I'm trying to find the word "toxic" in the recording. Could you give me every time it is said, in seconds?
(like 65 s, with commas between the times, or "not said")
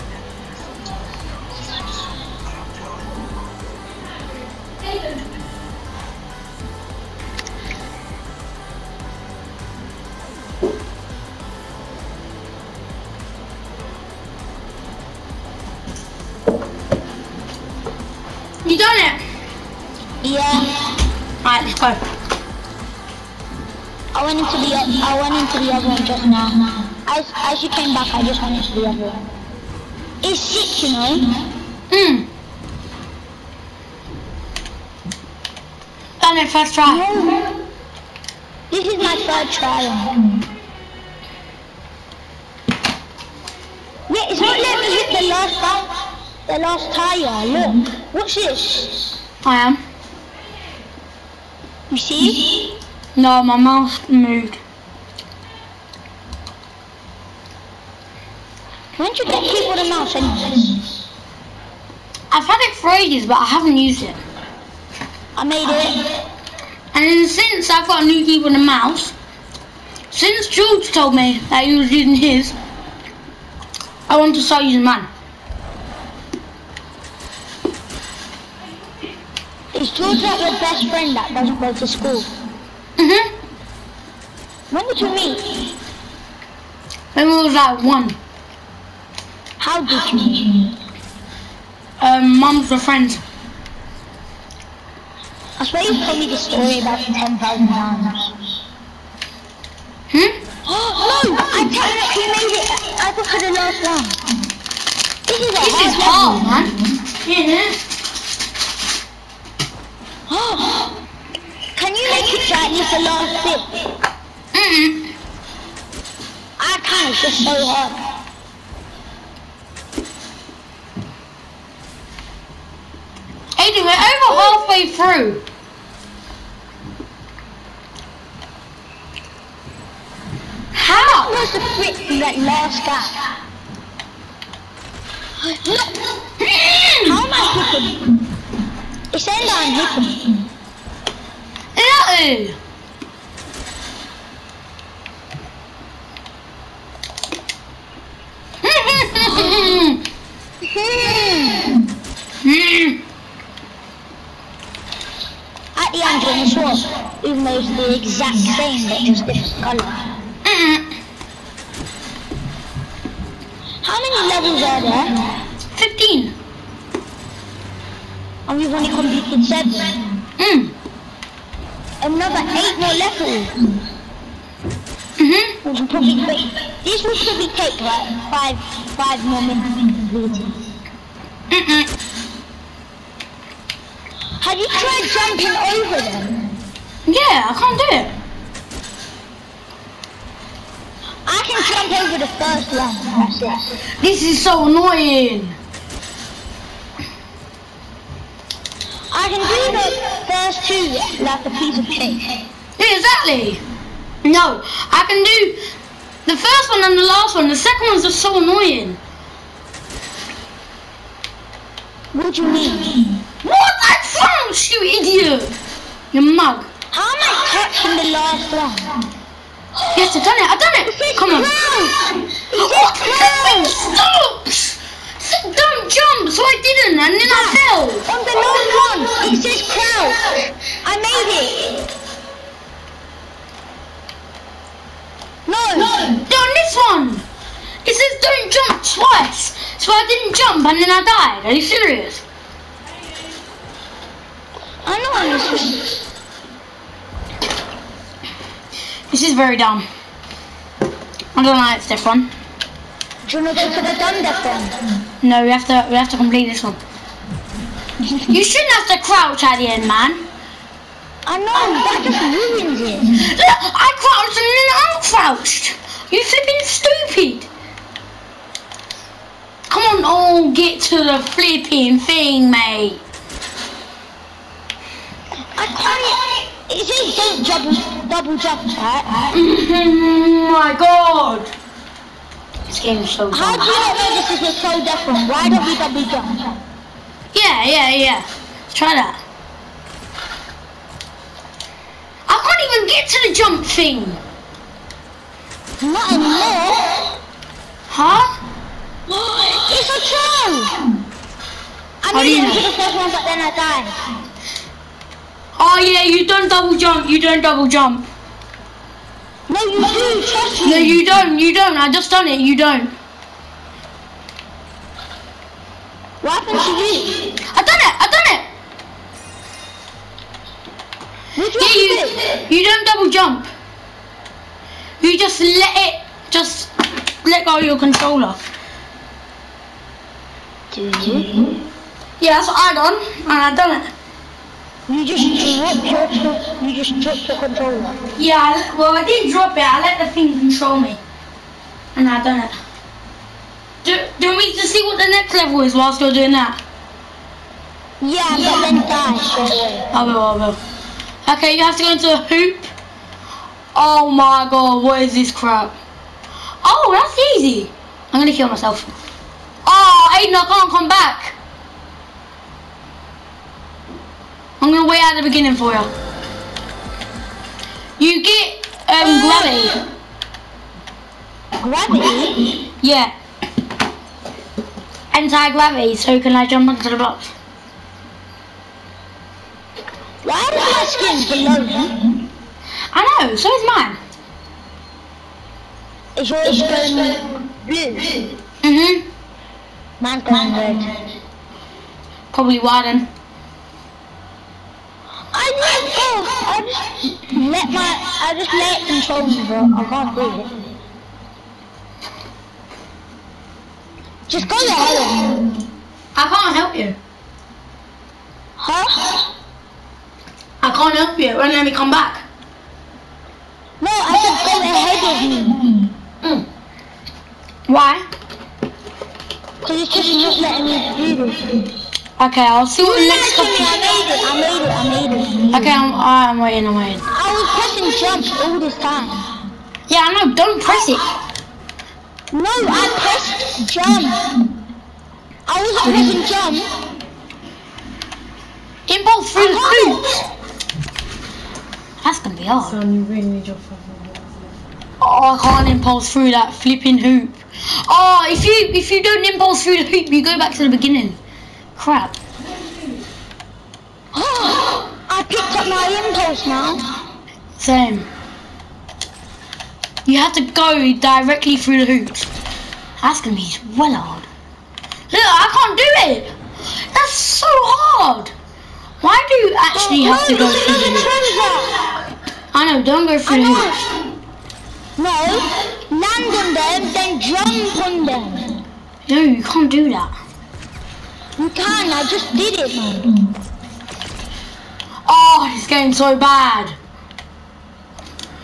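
not said.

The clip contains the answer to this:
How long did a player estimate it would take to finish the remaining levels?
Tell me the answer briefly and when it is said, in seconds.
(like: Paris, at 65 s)
5 minutes, at 178 s.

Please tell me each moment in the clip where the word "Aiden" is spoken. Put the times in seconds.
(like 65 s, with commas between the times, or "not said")
123 s, 360 s.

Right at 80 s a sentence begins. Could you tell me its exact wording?
That your best friend that doesn't go to school?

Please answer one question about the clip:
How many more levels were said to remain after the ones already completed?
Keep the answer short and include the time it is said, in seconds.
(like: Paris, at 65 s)
8, at 172 s.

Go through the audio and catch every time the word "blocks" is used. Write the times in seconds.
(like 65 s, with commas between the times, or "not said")
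376 s.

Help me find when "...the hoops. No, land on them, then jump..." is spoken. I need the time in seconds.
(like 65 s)
473 s.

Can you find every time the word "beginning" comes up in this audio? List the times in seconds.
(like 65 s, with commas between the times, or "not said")
365 s, 450 s.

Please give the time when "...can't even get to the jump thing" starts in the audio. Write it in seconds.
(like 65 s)
292 s.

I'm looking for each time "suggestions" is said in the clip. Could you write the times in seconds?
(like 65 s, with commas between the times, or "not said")
not said.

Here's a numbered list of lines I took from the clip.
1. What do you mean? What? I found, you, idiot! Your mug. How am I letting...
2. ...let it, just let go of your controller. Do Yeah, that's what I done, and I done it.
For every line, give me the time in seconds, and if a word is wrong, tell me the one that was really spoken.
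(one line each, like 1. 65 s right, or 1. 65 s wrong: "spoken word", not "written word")
1. 212 s wrong: "catching", not "letting"
2. 325 s right.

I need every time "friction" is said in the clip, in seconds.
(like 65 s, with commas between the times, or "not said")
not said.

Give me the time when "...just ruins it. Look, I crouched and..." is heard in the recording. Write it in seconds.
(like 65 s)
262 s.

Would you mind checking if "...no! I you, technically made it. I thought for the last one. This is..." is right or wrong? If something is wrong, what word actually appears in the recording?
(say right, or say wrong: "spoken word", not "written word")
right.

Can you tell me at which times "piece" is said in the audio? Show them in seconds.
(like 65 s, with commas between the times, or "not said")
201 s.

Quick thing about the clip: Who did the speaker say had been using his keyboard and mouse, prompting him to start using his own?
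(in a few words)
George.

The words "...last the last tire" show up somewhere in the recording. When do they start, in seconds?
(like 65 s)
45 s.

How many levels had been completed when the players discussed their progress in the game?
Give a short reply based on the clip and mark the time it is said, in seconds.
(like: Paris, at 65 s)
7, at 169 s.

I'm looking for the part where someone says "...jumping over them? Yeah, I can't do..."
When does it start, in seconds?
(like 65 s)
185 s.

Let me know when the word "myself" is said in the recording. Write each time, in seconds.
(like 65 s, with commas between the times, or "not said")
358 s.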